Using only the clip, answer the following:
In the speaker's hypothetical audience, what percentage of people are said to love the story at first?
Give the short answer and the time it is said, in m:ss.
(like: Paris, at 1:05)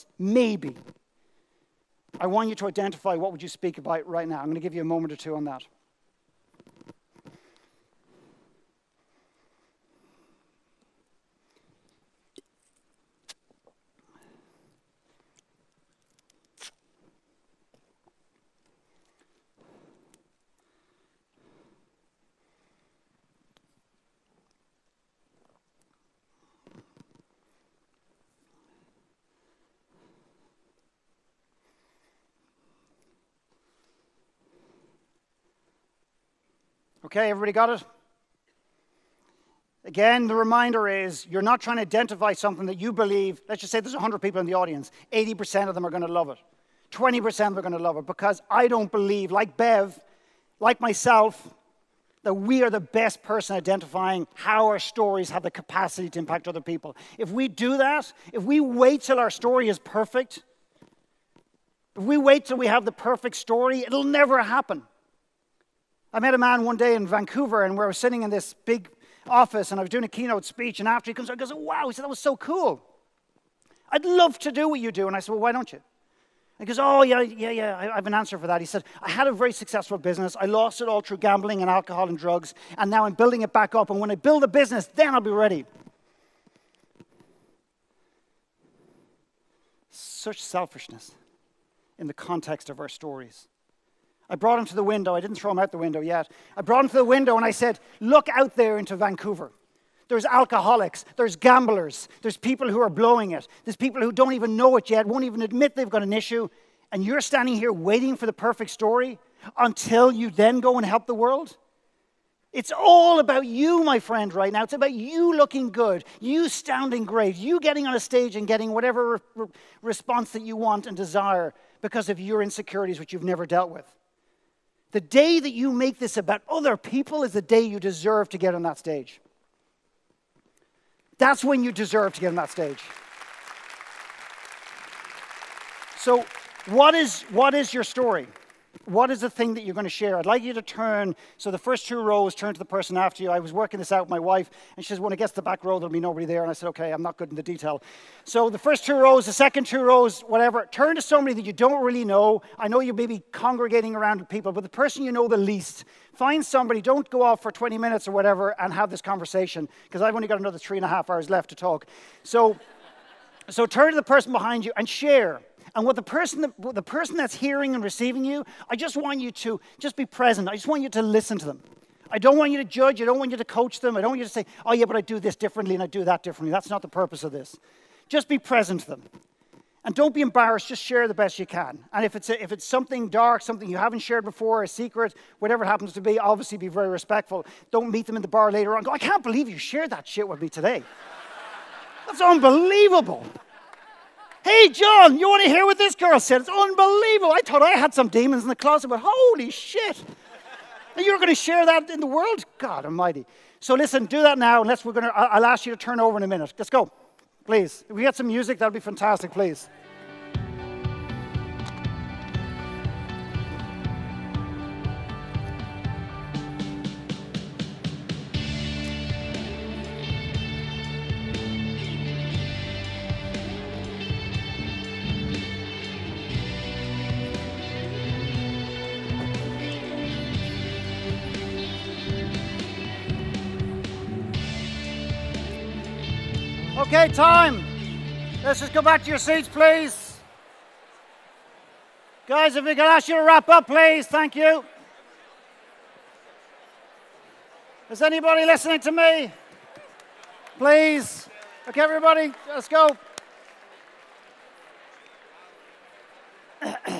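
80%, at 0:45.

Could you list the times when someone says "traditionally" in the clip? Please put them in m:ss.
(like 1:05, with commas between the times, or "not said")
not said.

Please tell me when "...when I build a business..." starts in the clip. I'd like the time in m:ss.
1:23.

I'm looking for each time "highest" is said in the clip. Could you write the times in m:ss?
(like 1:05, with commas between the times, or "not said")
not said.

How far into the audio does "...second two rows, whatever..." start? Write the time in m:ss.
2:29.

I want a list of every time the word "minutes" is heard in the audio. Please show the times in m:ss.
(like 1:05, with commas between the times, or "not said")
2:37, 3:26.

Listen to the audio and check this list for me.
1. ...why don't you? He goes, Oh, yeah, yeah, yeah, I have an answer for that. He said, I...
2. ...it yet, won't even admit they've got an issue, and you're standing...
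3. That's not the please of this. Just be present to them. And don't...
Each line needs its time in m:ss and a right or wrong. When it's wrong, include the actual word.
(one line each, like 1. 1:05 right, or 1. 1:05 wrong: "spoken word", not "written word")
1. 1:15 right
2. 1:44 right
3. 2:56 wrong: "purpose", not "please".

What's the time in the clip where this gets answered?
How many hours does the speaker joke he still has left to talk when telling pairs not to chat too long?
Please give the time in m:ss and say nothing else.
2:40.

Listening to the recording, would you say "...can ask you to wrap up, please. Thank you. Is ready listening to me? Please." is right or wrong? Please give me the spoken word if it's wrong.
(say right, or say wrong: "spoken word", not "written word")
wrong: "anybody", not "ready".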